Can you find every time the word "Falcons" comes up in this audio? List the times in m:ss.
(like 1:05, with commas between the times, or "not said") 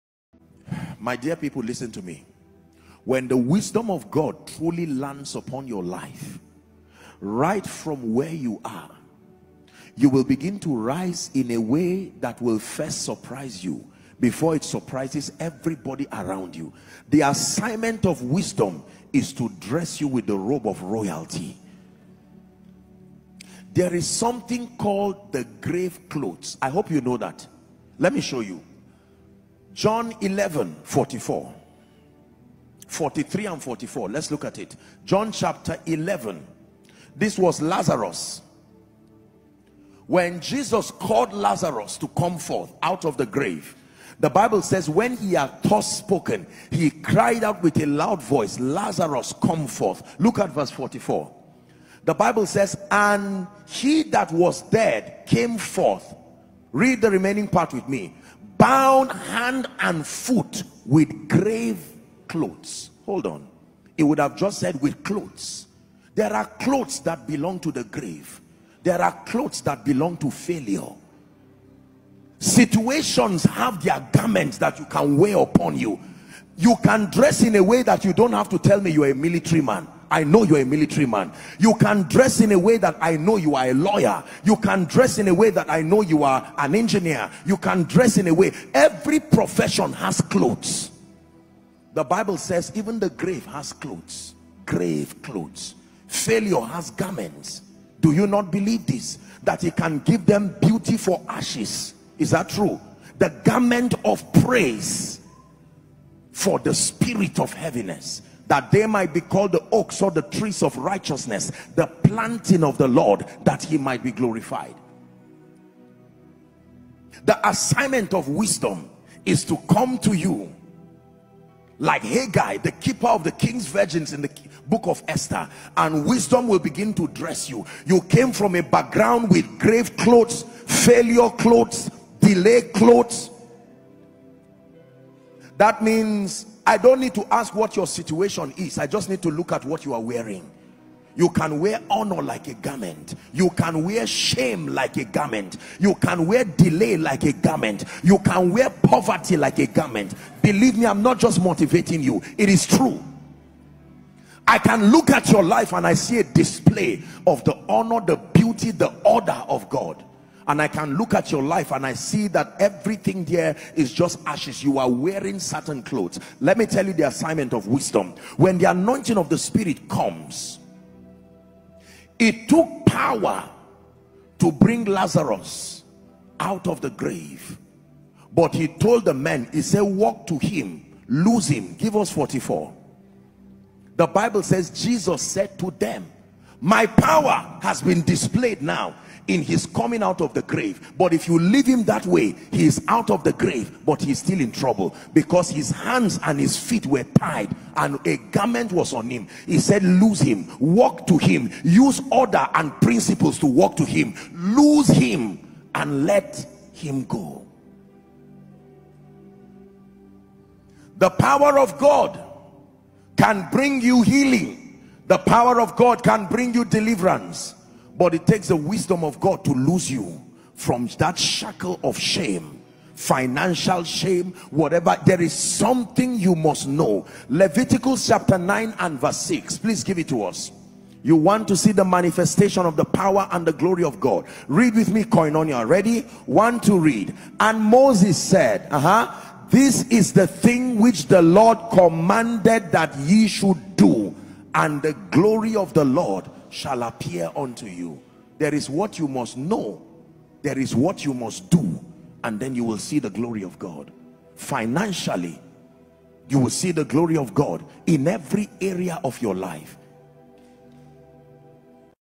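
not said.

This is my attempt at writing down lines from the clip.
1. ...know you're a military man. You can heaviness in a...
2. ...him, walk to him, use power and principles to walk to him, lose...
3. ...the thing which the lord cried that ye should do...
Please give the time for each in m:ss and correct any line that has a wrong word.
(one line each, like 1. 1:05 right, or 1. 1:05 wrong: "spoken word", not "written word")
1. 1:20 wrong: "dress", not "heaviness"
2. 3:20 wrong: "order", not "power"
3. 4:00 wrong: "commanded", not "cried".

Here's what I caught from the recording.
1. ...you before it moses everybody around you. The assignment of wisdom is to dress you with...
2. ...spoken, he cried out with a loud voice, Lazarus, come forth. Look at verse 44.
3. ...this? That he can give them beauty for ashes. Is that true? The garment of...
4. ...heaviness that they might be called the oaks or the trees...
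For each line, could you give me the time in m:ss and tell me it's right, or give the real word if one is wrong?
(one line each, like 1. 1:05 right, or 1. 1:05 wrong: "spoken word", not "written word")
1. 0:13 wrong: "surprises", not "moses"
2. 0:45 right
3. 1:38 right
4. 1:47 right.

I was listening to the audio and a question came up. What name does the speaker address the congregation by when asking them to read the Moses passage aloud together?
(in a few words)
Koinonia.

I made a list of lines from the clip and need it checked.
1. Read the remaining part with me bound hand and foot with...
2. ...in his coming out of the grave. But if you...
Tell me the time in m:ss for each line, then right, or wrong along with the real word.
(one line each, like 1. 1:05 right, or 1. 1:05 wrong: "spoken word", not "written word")
1. 0:56 right
2. 3:09 right.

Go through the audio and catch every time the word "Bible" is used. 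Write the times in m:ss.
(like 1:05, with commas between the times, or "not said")
0:44, 0:52, 1:32, 3:04.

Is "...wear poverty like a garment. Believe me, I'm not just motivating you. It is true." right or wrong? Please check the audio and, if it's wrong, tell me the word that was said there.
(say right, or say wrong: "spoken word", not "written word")
right.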